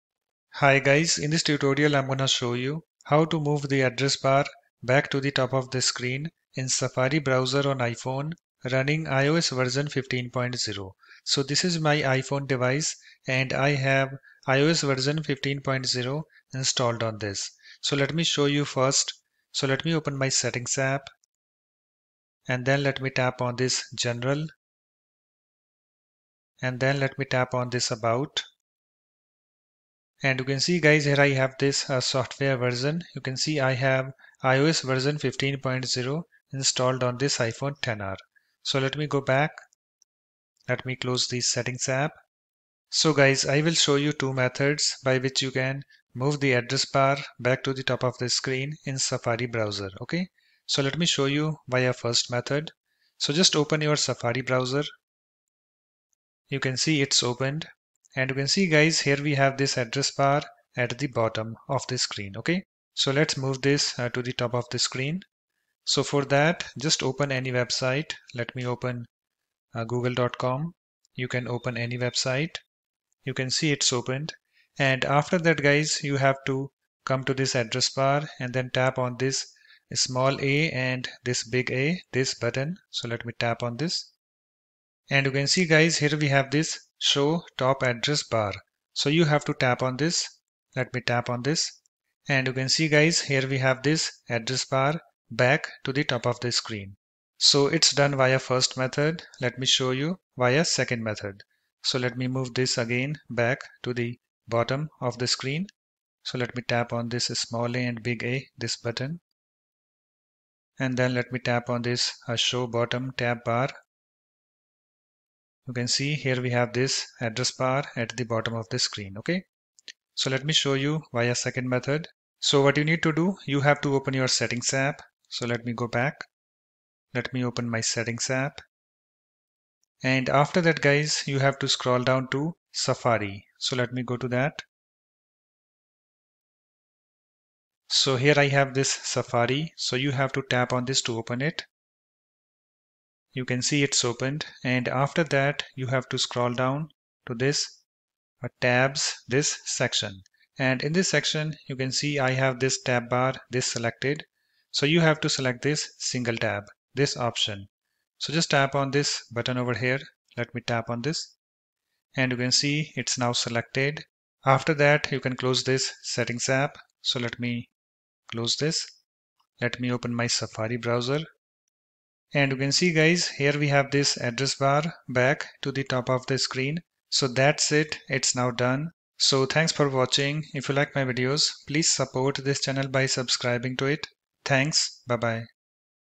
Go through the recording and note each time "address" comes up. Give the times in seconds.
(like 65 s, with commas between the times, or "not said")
3 s, 46 s, 59 s, 77 s, 87 s, 94 s, 117 s, 174 s.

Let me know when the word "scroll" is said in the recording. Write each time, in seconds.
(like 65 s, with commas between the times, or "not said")
131 s, 146 s.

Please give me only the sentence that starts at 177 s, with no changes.
So that's it, it's now done.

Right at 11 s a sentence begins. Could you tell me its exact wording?
So this is my iPhone device and I have iOS version 15.0 installed on this.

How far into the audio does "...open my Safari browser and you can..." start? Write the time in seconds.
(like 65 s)
169 s.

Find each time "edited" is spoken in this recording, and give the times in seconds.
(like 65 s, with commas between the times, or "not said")
not said.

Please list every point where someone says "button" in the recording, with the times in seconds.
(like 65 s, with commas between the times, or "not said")
82 s, 108 s, 159 s.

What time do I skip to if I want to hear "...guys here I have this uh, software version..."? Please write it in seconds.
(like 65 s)
30 s.